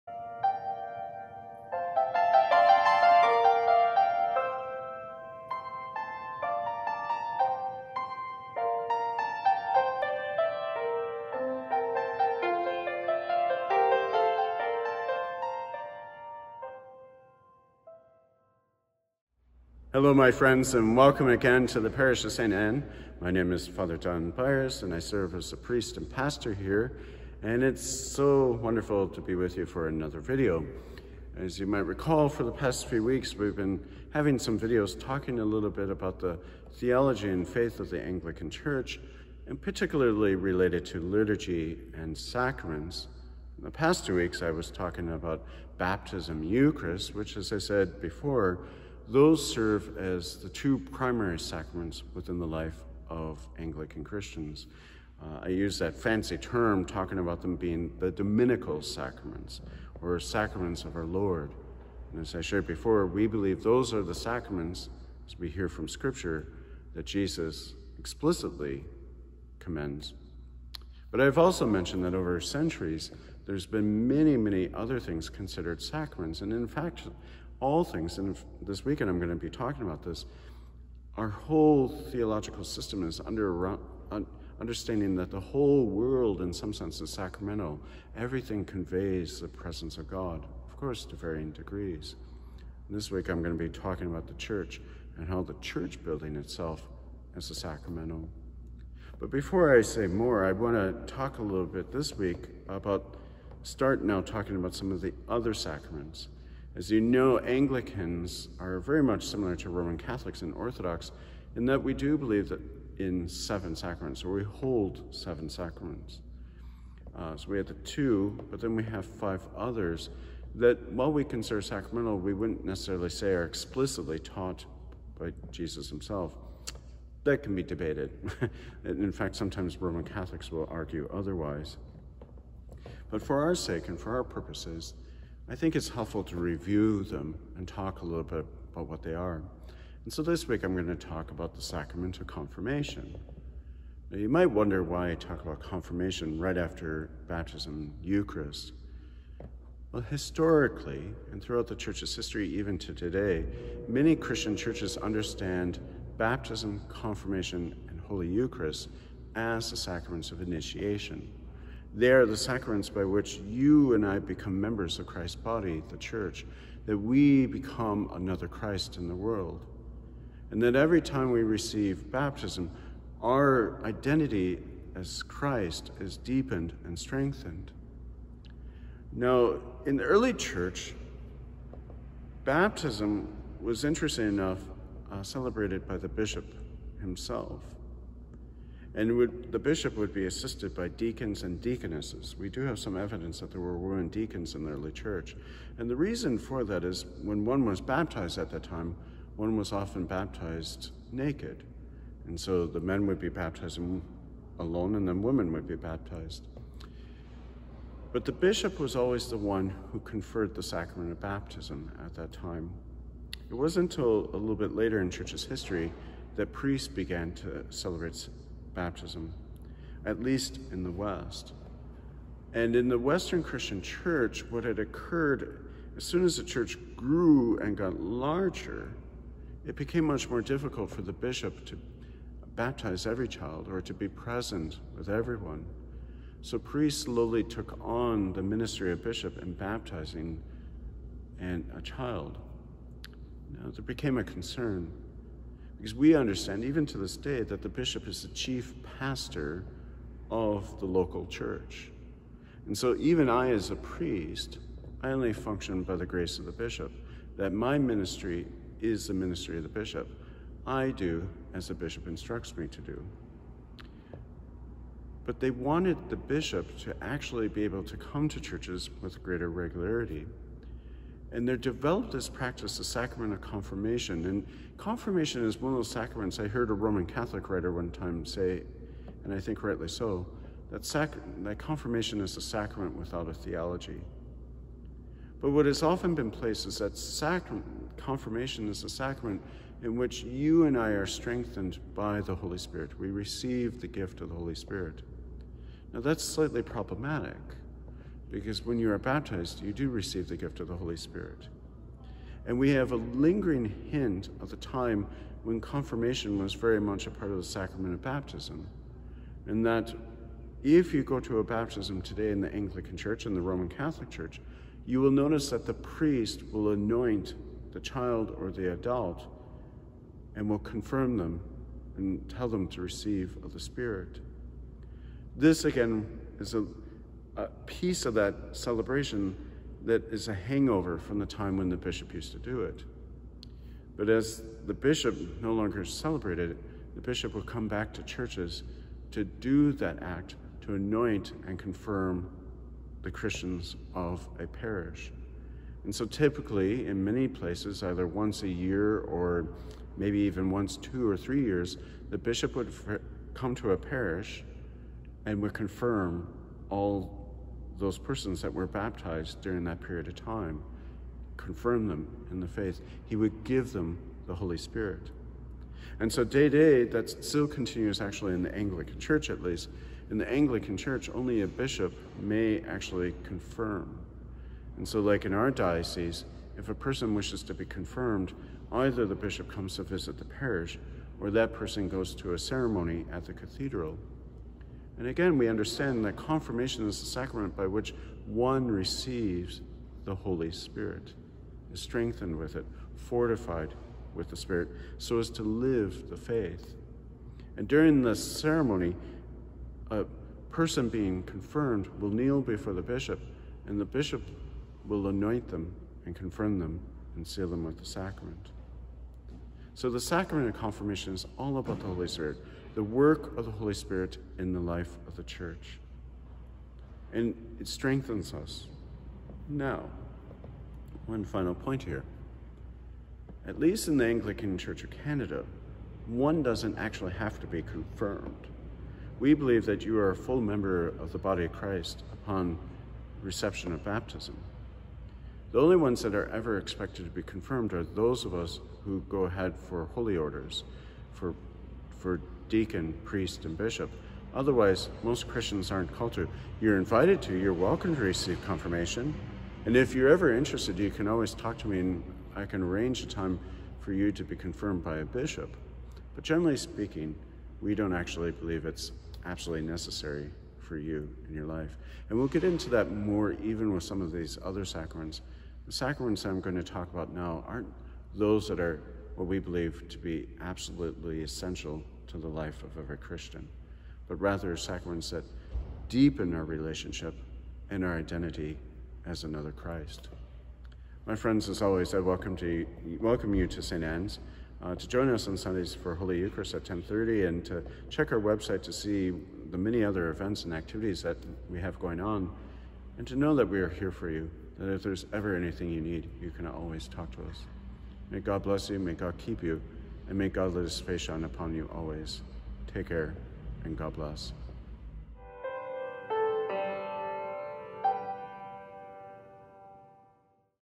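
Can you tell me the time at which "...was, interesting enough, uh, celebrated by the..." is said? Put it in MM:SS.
03:03.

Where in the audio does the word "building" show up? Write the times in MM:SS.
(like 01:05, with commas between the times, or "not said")
01:36.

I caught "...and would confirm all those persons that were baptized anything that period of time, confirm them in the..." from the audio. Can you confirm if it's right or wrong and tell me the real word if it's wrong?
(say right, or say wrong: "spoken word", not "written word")
wrong: "during", not "anything".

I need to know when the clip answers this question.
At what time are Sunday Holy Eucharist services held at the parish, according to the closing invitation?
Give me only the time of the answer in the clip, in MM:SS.
08:06.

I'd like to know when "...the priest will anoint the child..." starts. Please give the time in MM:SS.
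05:15.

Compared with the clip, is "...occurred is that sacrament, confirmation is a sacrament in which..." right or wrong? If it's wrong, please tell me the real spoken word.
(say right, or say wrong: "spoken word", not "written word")
wrong: "placed", not "occurred".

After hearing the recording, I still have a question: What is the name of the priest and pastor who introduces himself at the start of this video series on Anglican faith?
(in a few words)
Don Beyers.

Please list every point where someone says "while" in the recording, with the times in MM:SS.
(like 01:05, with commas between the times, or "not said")
02:00.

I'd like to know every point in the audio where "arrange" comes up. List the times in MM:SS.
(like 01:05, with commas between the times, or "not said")
07:32.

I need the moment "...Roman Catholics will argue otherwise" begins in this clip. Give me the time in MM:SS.
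02:09.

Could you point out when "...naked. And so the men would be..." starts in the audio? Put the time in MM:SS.
03:21.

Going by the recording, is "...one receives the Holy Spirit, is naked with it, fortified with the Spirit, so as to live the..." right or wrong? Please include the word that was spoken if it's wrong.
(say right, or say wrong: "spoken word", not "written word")
wrong: "strengthened", not "naked".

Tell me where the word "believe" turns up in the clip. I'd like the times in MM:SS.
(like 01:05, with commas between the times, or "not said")
01:03, 01:52, 07:09, 07:38, 07:49.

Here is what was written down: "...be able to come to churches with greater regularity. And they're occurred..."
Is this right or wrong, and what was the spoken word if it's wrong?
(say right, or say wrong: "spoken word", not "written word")
wrong: "developed", not "occurred".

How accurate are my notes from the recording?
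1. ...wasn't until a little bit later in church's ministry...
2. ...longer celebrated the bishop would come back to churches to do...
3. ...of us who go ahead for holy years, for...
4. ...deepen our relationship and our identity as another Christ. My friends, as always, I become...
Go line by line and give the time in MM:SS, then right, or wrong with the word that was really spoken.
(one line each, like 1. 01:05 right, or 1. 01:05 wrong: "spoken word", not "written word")
1. 03:33 wrong: "history", not "ministry"
2. 05:35 right
3. 07:18 wrong: "orders", not "years"
4. 07:55 wrong: "welcome", not "become".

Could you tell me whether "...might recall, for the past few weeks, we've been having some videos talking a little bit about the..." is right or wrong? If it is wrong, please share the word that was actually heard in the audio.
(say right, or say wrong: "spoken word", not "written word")
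right.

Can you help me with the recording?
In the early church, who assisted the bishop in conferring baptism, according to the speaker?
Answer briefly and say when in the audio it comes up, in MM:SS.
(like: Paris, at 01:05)
deacons and deaconesses, at 03:10.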